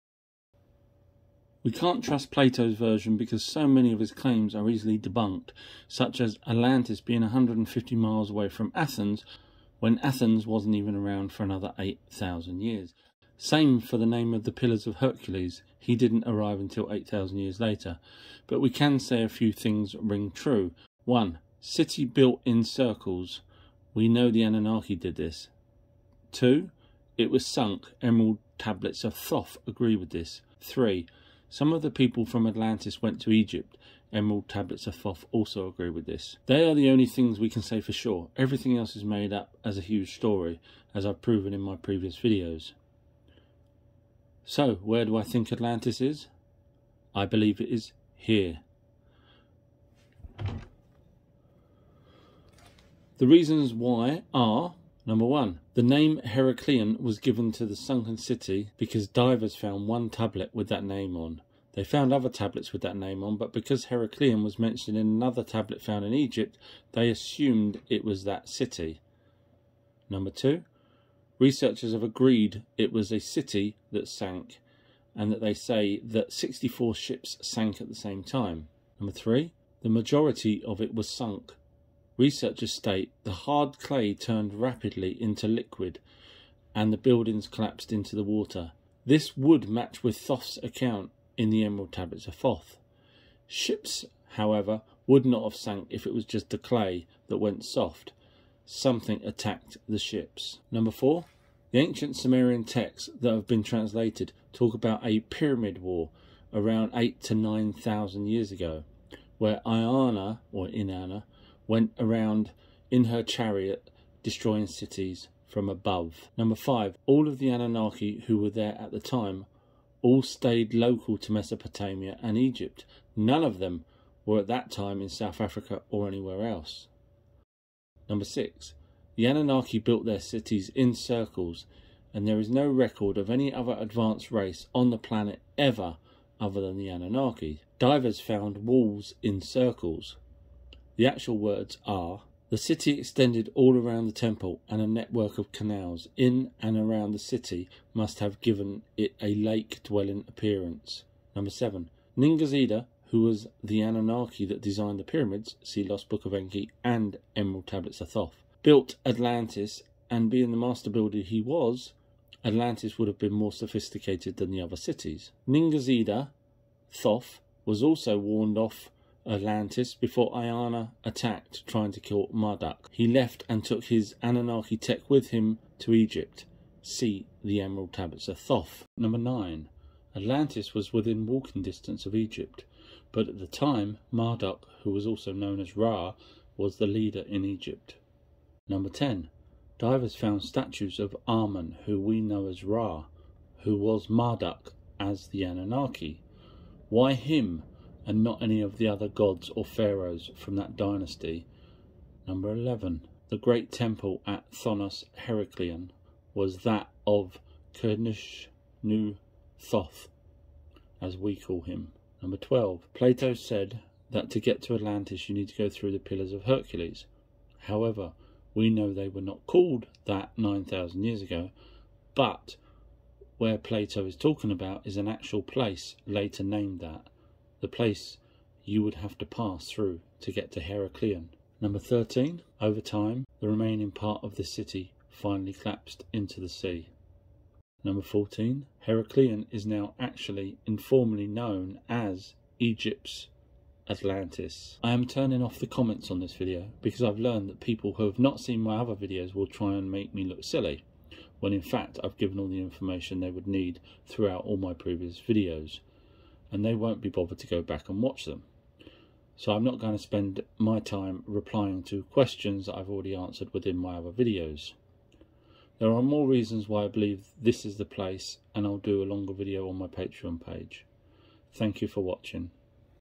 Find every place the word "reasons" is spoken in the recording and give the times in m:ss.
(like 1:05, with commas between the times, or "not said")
0:53, 4:26.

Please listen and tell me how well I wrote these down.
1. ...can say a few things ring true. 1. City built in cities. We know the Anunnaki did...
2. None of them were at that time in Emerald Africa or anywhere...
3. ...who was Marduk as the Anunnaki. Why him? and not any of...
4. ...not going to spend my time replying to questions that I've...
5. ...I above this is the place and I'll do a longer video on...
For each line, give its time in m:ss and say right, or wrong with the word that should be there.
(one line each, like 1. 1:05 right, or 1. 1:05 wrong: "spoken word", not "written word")
1. 0:18 wrong: "circles", not "cities"
2. 2:03 wrong: "South", not "Emerald"
3. 3:13 right
4. 4:19 right
5. 4:26 wrong: "believe", not "above".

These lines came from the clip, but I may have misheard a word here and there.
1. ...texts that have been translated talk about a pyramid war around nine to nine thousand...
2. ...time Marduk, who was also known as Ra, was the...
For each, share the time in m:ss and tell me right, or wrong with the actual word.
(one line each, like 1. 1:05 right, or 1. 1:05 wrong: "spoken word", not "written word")
1. 1:42 wrong: "eight", not "nine"
2. 3:03 right.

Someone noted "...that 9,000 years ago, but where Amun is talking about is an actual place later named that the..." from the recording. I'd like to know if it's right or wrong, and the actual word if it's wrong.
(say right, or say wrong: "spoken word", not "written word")
wrong: "Plato", not "Amun".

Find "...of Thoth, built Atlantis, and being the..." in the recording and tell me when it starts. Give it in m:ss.
2:37.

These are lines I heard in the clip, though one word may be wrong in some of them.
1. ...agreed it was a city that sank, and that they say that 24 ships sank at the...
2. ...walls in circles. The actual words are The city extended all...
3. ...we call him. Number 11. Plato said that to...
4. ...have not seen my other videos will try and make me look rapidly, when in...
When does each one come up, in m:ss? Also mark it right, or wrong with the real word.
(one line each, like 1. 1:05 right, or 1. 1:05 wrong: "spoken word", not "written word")
1. 1:12 wrong: "64", not "24"
2. 2:18 right
3. 3:31 wrong: "12", not "11"
4. 4:08 wrong: "silly", not "rapidly".